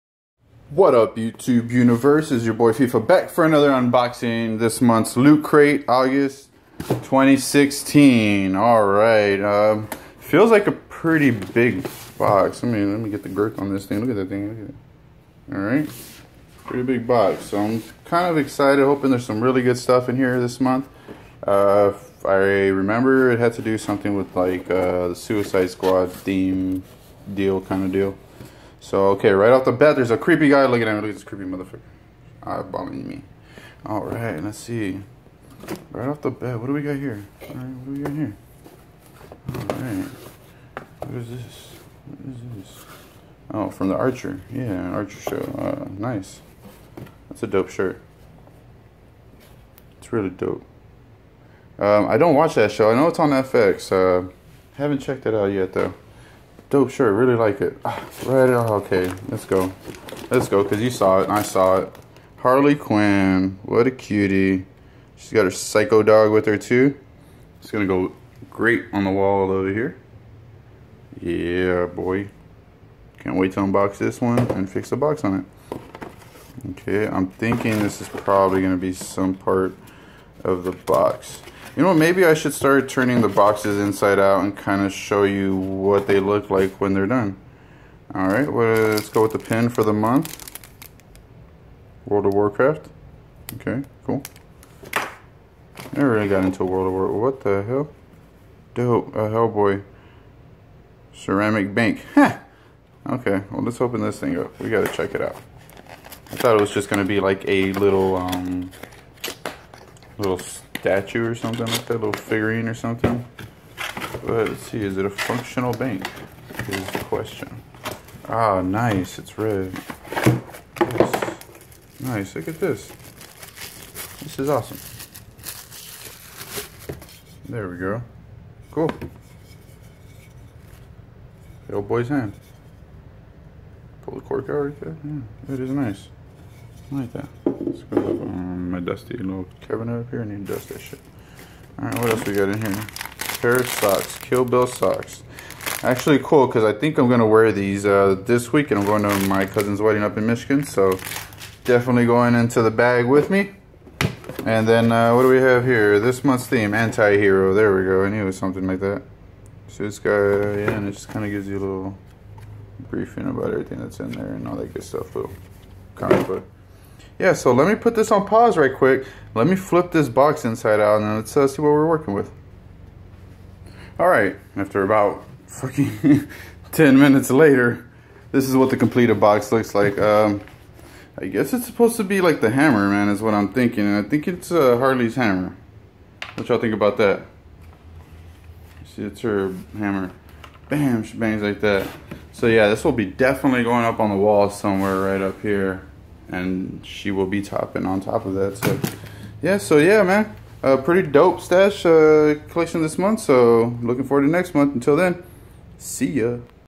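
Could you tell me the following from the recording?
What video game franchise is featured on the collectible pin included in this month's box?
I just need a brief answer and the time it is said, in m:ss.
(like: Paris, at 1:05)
World of Warcraft, at 1:32.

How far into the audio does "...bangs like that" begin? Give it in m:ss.
3:11.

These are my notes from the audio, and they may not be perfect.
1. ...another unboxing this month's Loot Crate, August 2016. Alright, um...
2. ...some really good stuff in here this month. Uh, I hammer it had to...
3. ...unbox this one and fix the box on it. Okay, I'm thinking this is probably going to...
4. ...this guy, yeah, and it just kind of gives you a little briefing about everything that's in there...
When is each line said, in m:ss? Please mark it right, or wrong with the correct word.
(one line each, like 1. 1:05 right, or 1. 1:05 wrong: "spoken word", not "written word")
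1. 0:03 right
2. 0:19 wrong: "remember", not "hammer"
3. 1:13 right
4. 2:39 right.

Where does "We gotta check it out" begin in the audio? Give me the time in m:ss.
1:44.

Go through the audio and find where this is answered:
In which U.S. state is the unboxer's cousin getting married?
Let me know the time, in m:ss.
2:30.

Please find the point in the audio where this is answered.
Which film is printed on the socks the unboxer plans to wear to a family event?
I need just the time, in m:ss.
2:24.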